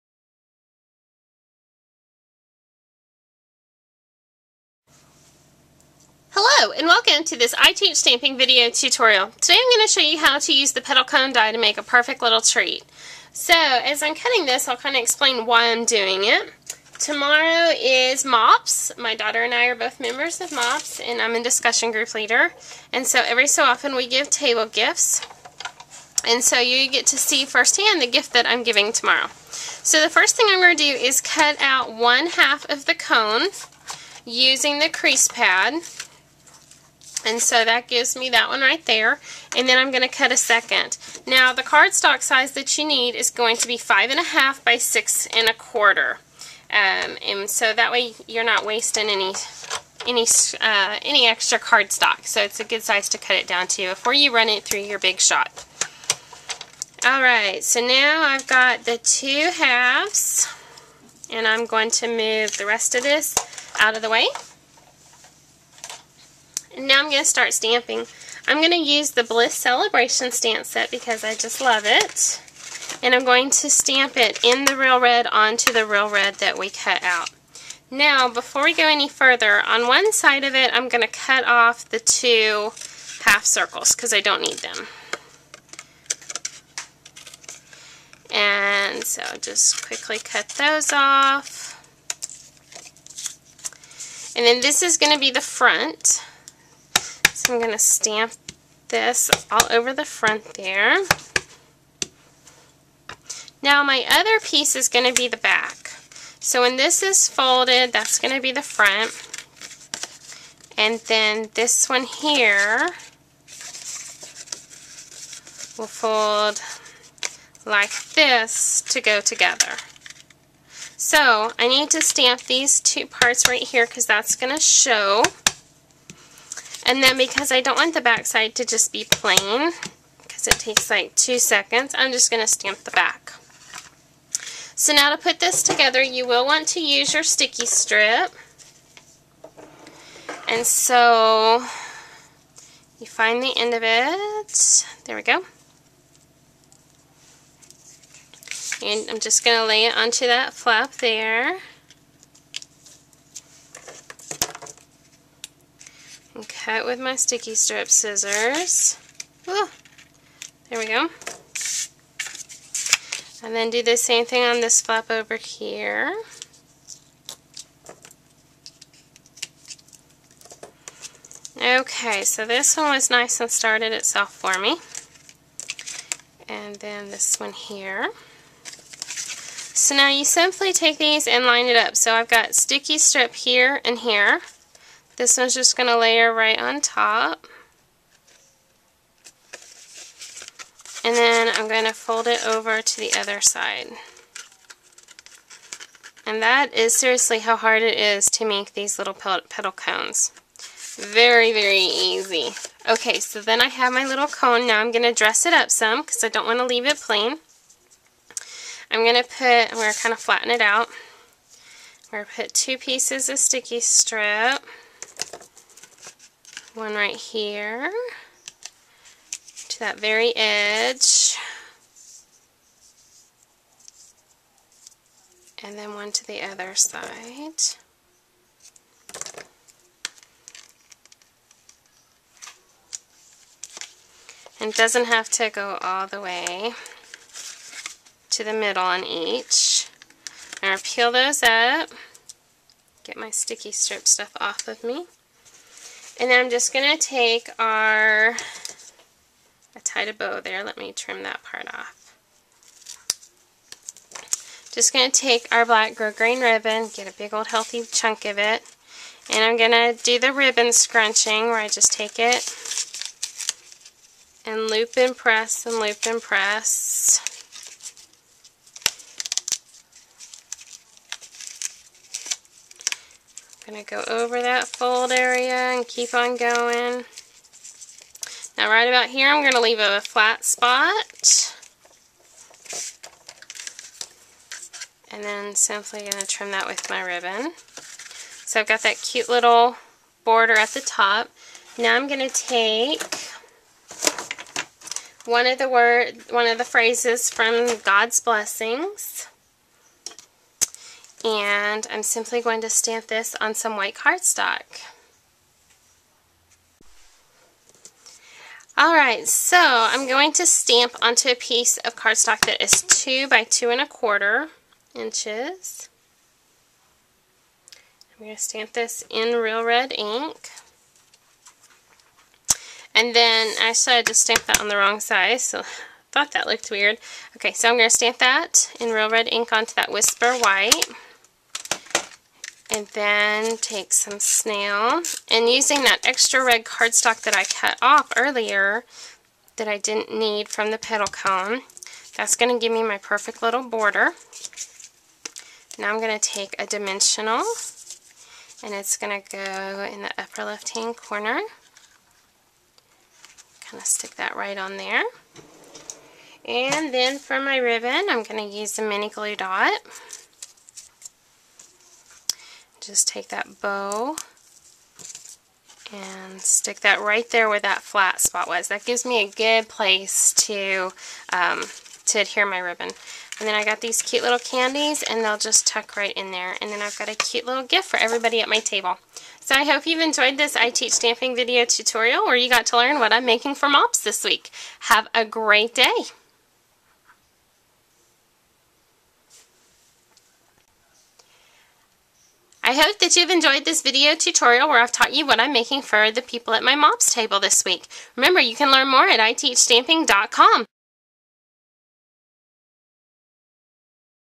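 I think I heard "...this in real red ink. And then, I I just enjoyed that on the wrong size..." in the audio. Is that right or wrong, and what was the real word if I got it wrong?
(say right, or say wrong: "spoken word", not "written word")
wrong: "stamped", not "enjoyed".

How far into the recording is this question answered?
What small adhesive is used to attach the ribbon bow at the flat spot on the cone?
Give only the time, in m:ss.
5:58.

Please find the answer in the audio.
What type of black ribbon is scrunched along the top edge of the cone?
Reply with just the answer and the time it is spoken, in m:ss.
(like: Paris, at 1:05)
grosgrain, at 4:15.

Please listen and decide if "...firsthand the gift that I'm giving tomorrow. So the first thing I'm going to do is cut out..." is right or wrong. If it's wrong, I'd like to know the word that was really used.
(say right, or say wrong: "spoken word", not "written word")
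right.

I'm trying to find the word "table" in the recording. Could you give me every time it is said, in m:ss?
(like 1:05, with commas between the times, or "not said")
0:24, 6:18, 6:37.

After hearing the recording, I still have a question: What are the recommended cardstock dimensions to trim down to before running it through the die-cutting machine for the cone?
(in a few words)
5 1/2 by 6 1/4.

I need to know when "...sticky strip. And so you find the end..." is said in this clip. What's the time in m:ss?
2:17.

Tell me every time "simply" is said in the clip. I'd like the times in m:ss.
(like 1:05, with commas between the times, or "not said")
3:00, 4:45, 5:02.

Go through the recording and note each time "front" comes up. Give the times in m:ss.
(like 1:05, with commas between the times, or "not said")
1:35, 1:40, 1:48.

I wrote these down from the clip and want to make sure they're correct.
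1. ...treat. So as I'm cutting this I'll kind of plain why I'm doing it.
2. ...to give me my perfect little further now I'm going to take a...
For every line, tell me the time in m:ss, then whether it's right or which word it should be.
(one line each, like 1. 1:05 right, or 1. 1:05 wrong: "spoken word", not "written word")
1. 0:12 wrong: "explain", not "plain"
2. 5:42 wrong: "border", not "further".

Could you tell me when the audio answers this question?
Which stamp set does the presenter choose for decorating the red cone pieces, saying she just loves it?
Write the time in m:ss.
1:09.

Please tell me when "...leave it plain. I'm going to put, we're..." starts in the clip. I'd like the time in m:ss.
3:26.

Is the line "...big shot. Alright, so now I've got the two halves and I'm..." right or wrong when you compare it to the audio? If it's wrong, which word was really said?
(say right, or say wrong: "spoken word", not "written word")
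right.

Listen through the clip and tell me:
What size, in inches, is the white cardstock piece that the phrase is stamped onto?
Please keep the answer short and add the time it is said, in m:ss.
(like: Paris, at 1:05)
2 by 2 1/4 inches, at 5:12.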